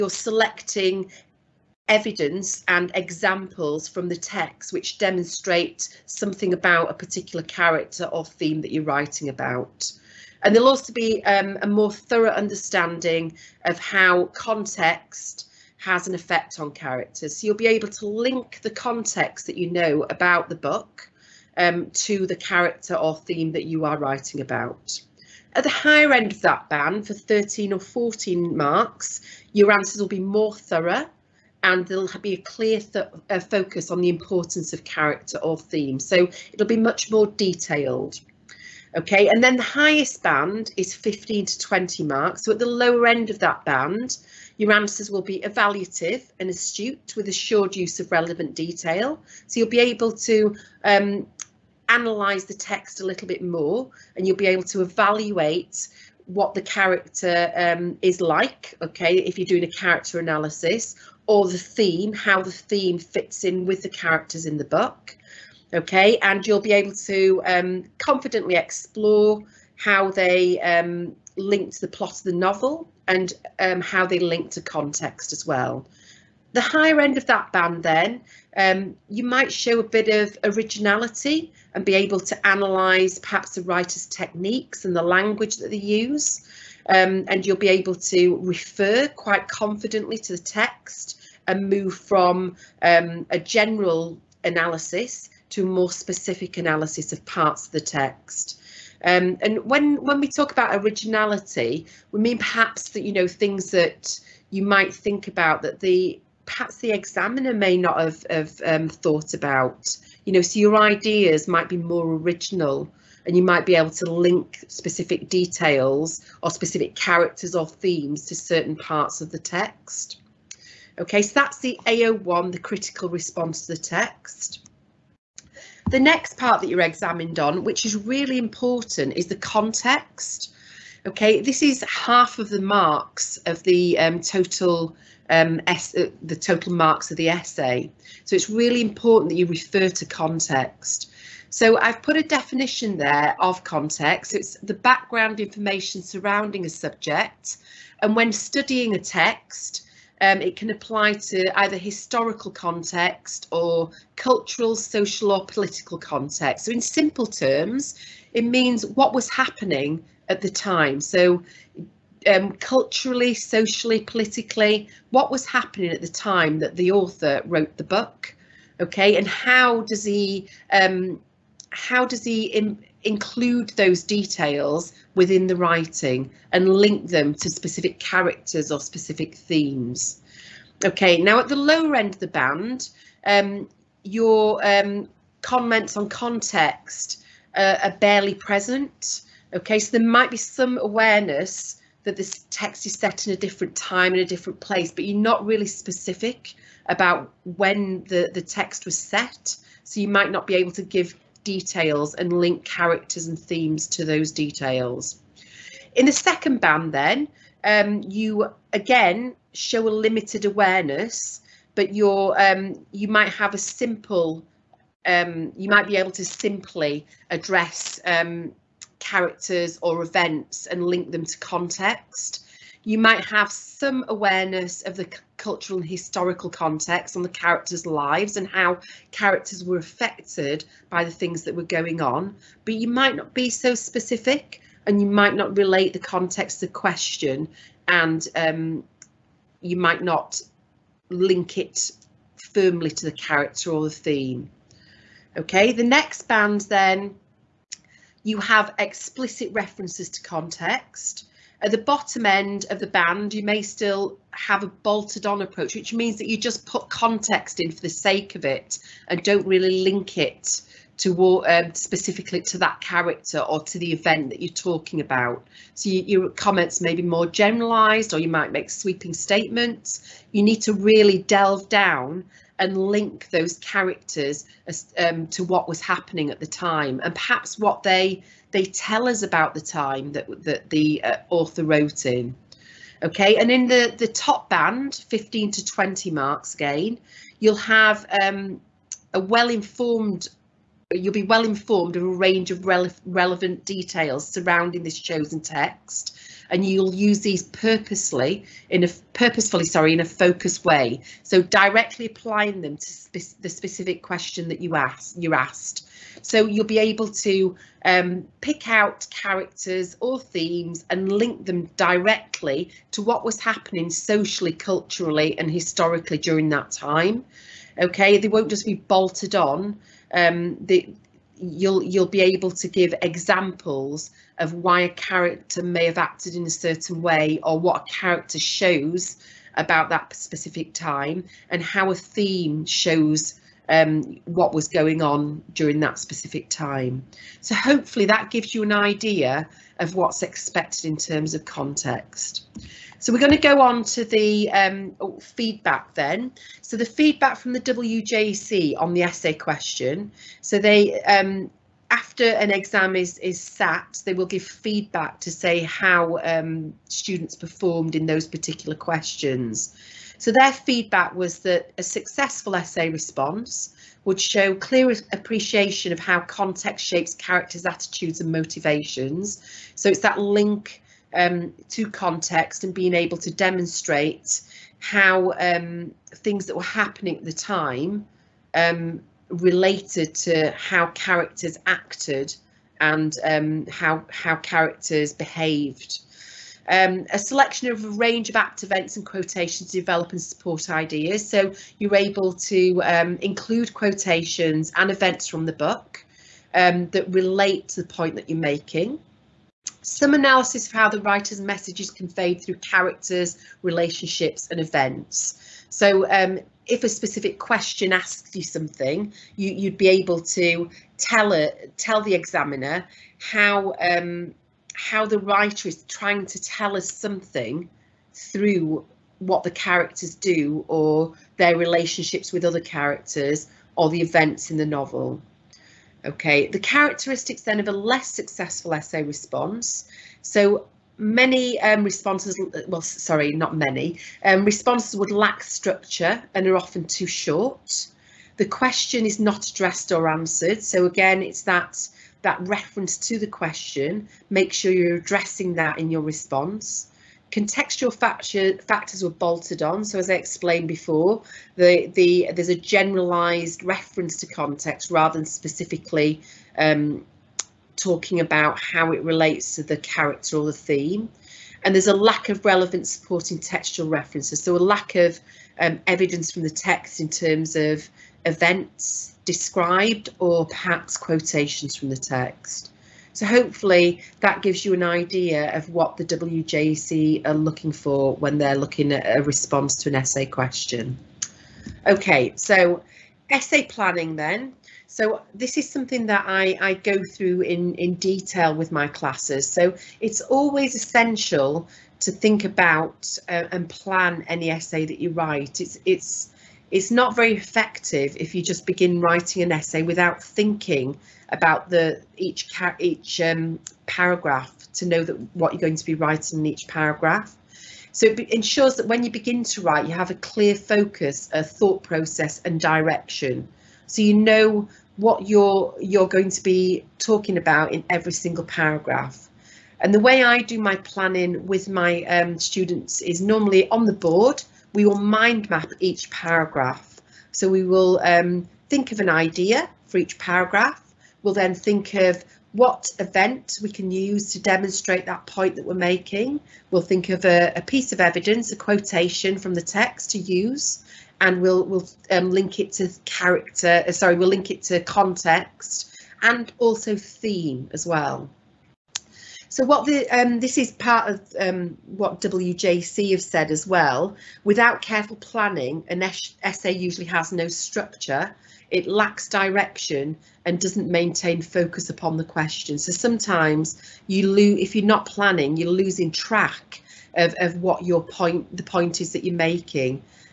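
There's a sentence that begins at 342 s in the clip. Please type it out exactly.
So we're going to go on to the um, oh, feedback then.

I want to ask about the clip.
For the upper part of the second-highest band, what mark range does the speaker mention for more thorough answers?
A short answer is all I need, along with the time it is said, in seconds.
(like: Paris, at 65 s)
13 or 14, at 27 s.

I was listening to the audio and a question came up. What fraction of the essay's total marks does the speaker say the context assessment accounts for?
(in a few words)
half.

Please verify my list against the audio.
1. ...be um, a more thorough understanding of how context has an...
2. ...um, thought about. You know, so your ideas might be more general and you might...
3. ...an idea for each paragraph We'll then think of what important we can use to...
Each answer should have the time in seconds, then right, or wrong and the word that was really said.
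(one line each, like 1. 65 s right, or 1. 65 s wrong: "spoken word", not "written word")
1. 10 s right
2. 108 s wrong: "original", not "general"
3. 528 s wrong: "event", not "important".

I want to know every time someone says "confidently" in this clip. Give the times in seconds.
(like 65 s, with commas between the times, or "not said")
67 s, 89 s.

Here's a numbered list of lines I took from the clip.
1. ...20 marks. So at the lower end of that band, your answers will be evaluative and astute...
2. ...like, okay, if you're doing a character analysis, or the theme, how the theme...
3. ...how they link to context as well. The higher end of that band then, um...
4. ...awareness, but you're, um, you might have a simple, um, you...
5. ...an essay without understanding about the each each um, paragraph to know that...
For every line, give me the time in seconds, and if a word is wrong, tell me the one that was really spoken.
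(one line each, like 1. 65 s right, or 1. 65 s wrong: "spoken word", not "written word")
1. 41 s right
2. 58 s right
3. 73 s right
4. 210 s right
5. 499 s wrong: "thinking", not "understanding".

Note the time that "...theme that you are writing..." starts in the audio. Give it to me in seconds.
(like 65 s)
23 s.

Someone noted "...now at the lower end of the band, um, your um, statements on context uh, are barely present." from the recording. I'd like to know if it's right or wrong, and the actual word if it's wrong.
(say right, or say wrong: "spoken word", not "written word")
wrong: "comments", not "statements".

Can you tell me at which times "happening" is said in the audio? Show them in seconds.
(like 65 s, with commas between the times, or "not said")
159 s, 165 s, 275 s, 313 s, 376 s.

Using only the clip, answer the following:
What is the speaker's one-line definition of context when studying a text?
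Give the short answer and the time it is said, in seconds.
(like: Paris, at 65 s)
background information surrounding a subject, at 144 s.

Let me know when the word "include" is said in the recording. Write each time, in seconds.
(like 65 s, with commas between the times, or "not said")
173 s, 393 s.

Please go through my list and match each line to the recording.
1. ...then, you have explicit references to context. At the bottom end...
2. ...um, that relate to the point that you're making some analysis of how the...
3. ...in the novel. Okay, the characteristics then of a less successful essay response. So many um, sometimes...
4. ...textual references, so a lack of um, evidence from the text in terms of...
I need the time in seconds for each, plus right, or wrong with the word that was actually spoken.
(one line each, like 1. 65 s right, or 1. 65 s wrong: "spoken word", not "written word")
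1. 246 s right
2. 396 s right
3. 424 s wrong: "responses", not "sometimes"
4. 463 s right.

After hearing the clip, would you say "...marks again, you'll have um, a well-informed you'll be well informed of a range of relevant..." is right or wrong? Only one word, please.
right.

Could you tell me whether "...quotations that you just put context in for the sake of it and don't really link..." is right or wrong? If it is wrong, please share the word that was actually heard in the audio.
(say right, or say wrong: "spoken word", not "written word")
wrong: "means", not "quotations".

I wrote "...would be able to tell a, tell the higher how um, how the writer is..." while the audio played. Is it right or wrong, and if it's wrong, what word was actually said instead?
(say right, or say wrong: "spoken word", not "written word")
wrong: "examiner", not "higher".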